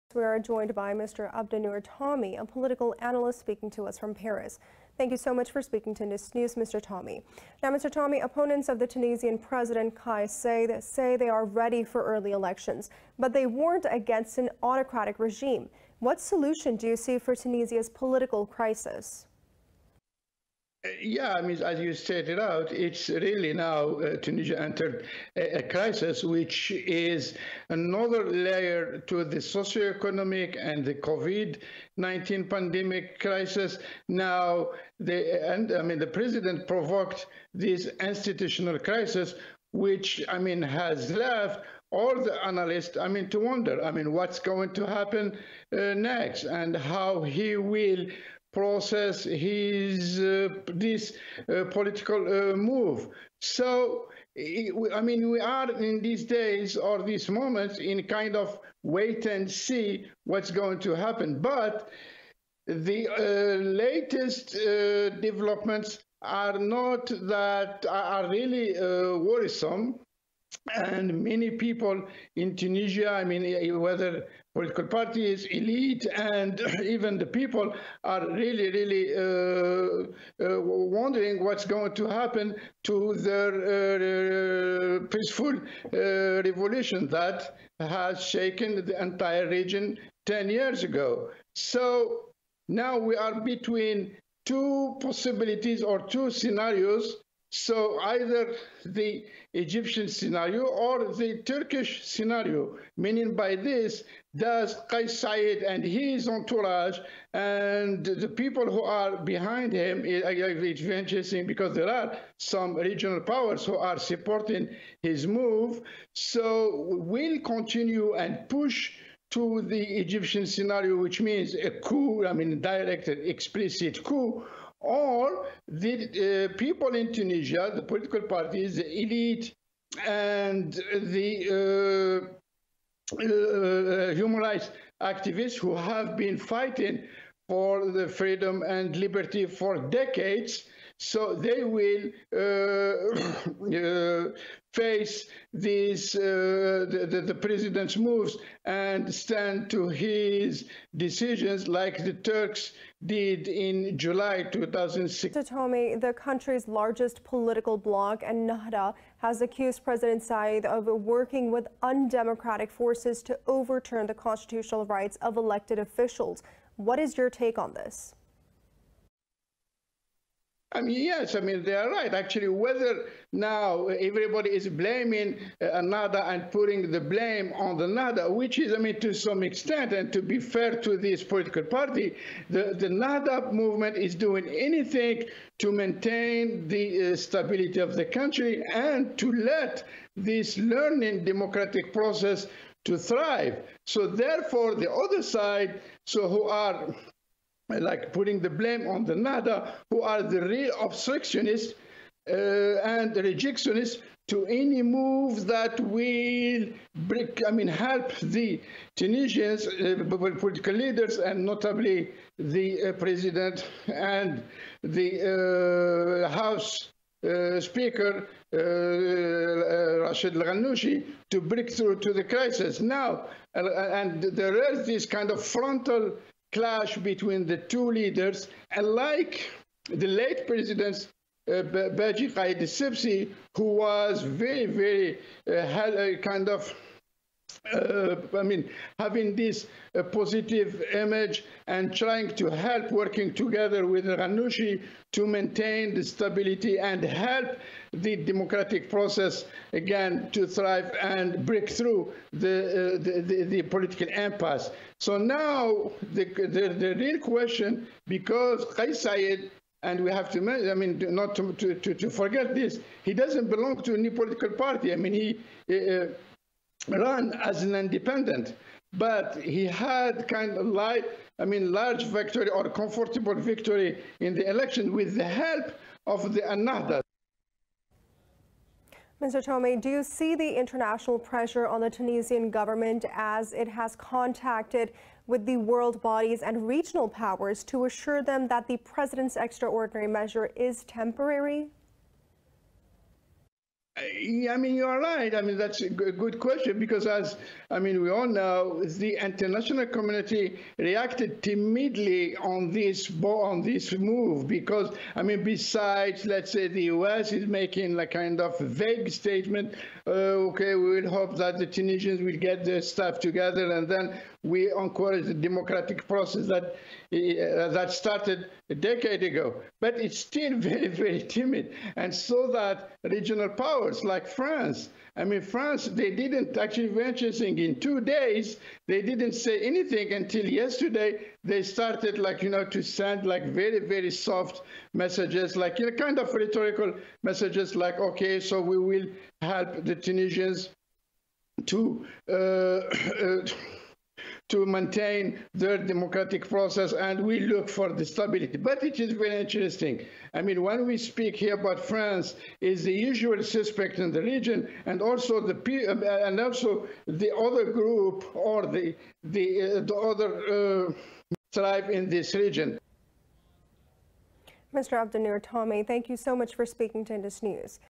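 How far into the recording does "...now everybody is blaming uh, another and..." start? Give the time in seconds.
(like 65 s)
173 s.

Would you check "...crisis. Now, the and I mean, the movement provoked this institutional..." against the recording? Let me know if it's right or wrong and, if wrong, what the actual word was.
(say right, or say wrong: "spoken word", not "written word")
wrong: "president", not "movement".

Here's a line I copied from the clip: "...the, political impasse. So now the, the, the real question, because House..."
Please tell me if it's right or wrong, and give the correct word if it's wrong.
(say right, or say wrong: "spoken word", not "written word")
wrong: "Kais", not "House".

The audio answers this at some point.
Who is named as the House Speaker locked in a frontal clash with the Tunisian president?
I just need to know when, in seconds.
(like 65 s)
220 s.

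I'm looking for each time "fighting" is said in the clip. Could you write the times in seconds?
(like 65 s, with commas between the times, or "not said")
136 s.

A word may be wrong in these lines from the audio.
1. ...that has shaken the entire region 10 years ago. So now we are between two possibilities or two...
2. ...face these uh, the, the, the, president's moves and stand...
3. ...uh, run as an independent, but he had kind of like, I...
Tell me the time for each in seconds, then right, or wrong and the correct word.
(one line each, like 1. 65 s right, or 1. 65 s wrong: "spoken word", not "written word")
1. 87 s right
2. 144 s right
3. 265 s right.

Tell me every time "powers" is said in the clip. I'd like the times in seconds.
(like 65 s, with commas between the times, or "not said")
113 s, 287 s, 323 s.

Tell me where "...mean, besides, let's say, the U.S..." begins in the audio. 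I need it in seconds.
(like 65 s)
305 s.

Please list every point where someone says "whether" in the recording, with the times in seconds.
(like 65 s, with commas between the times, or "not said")
73 s, 172 s.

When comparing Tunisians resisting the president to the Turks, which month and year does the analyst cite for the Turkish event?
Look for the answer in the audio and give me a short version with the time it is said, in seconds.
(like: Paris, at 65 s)
July 2006, at 153 s.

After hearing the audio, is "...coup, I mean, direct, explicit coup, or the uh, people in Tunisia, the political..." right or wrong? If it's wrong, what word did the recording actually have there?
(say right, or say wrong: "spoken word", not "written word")
right.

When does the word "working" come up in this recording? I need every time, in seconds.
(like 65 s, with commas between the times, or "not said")
160 s, 242 s.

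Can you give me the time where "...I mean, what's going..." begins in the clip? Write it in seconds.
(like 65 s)
43 s.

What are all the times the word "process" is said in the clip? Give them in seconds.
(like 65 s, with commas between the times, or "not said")
48 s, 191 s, 248 s, 316 s, 346 s.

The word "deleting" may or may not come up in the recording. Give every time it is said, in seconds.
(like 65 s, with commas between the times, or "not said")
not said.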